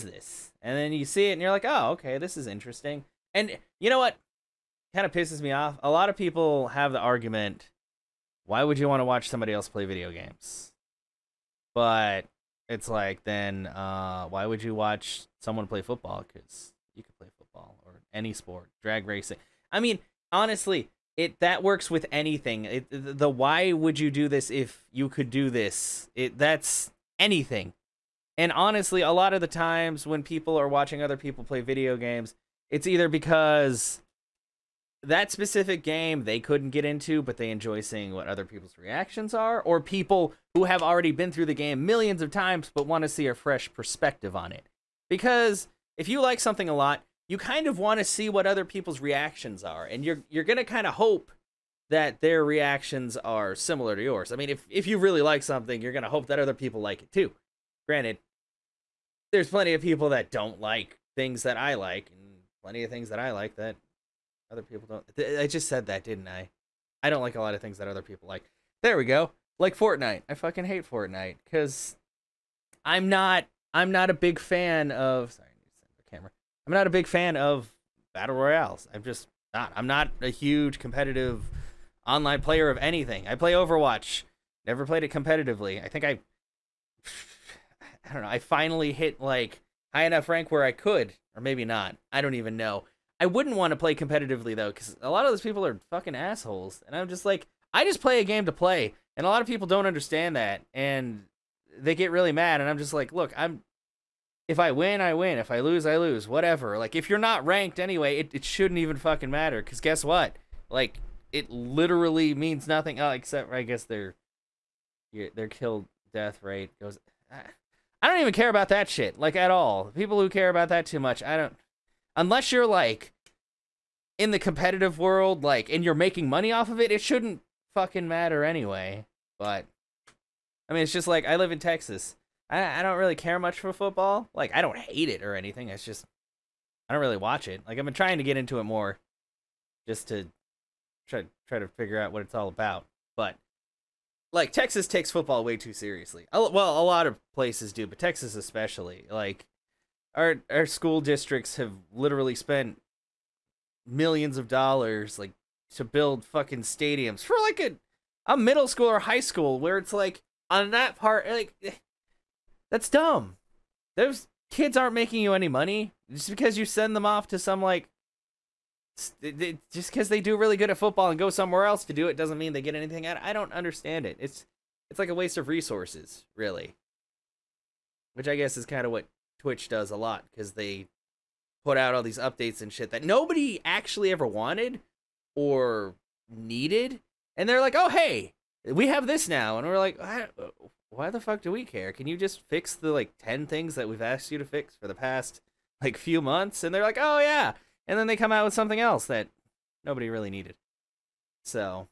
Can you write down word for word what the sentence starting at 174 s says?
It's it's like a waste of resources, really.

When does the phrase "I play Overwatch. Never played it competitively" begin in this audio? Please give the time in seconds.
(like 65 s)
83 s.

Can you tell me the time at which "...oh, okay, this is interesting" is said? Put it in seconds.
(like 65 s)
1 s.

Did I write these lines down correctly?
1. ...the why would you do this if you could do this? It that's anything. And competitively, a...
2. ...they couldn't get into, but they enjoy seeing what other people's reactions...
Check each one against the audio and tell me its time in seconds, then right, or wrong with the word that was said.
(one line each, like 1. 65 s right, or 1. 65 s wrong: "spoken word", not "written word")
1. 22 s wrong: "honestly", not "competitively"
2. 36 s right.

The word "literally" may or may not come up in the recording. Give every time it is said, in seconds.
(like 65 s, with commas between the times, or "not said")
111 s, 151 s.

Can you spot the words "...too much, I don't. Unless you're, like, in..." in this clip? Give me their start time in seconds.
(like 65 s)
120 s.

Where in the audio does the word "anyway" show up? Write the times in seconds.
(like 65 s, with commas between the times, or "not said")
107 s, 128 s.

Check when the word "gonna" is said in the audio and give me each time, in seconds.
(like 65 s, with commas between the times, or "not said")
50 s, 55 s.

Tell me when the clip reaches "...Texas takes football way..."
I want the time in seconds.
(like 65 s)
144 s.